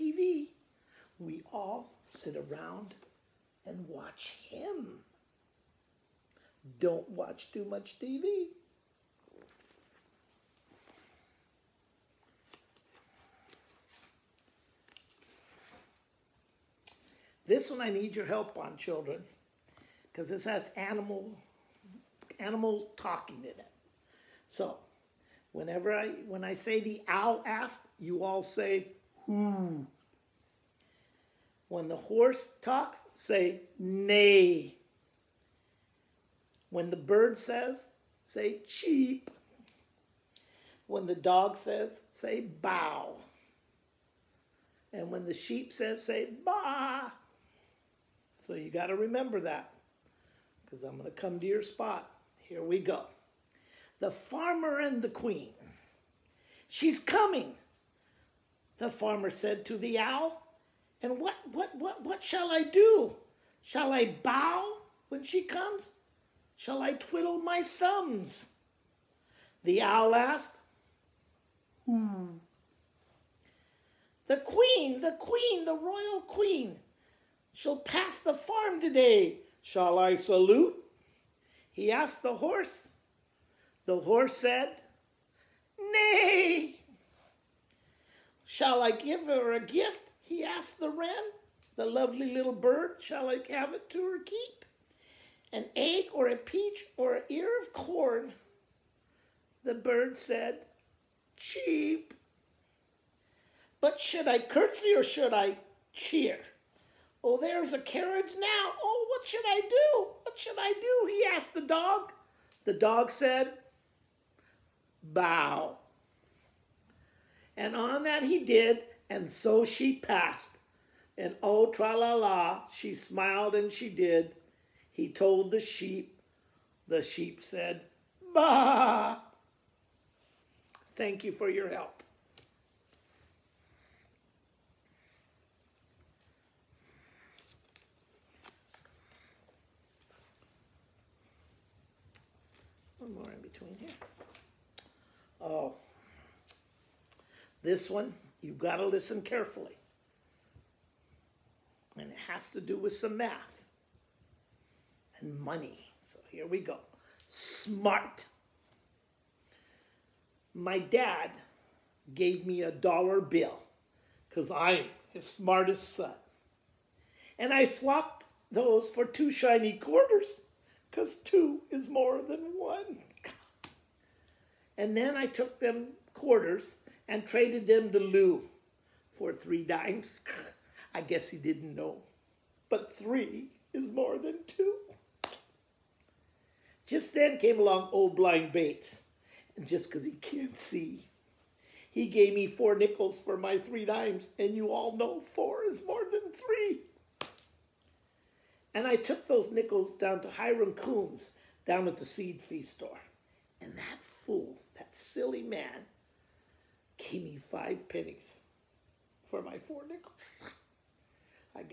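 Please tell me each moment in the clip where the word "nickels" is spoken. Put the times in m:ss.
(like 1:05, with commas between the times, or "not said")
3:12, 3:19, 3:29.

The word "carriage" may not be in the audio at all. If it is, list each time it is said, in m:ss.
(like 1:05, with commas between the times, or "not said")
1:47.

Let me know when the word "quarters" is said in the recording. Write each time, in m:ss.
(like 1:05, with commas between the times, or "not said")
2:49, 2:56.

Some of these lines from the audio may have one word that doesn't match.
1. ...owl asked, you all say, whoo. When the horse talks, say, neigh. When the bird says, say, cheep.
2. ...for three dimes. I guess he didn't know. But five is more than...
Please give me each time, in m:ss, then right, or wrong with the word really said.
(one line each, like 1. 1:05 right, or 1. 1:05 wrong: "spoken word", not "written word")
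1. 0:27 right
2. 2:59 wrong: "three", not "five".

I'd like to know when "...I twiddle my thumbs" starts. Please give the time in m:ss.
1:06.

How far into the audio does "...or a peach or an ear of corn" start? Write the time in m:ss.
1:36.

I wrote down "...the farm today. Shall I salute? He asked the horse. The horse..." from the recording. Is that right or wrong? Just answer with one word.
right.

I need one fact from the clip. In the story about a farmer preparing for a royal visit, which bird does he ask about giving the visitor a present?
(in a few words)
wren.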